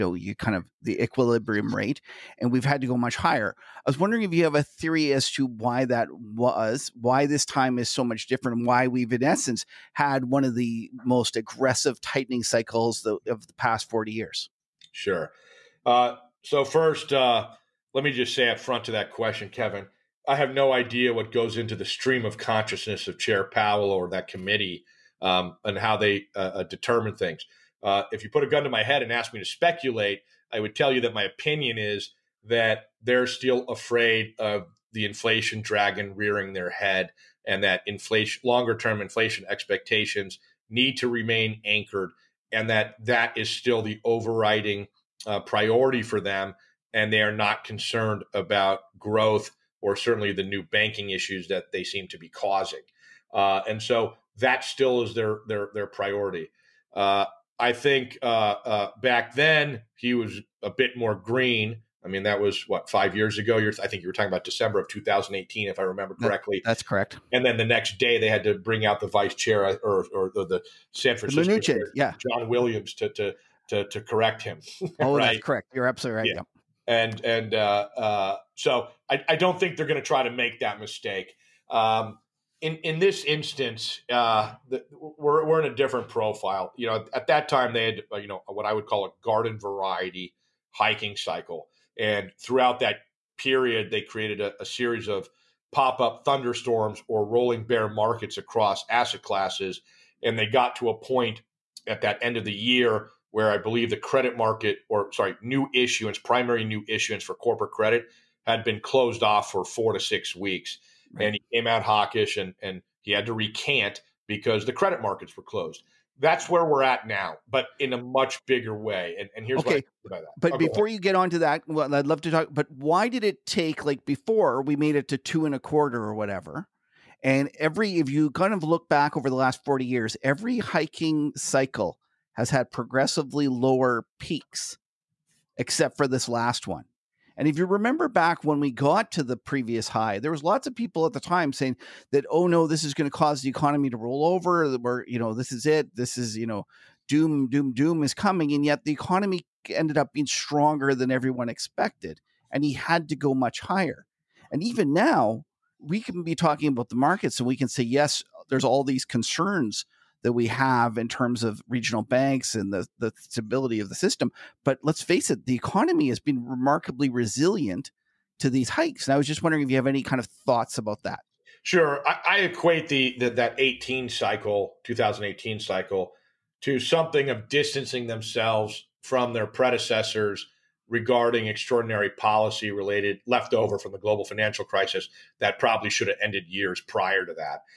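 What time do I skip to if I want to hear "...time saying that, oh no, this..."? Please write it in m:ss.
2:21.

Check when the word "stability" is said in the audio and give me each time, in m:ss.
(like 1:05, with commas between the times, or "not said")
2:43.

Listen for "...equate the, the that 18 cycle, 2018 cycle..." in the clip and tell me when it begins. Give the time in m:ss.
2:52.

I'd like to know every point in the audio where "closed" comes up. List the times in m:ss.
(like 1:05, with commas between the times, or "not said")
1:48, 1:55.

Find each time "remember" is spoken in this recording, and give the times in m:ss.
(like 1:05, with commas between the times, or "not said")
1:05, 2:17.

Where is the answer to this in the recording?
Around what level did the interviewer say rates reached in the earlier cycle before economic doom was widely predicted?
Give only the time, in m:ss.
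2:05.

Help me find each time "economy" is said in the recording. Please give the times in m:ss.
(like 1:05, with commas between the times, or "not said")
2:23, 2:28, 2:45.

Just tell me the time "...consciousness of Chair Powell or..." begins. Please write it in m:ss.
0:22.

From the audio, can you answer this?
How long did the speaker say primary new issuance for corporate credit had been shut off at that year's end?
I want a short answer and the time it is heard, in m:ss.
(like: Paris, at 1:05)
4 to 6 weeks, at 1:49.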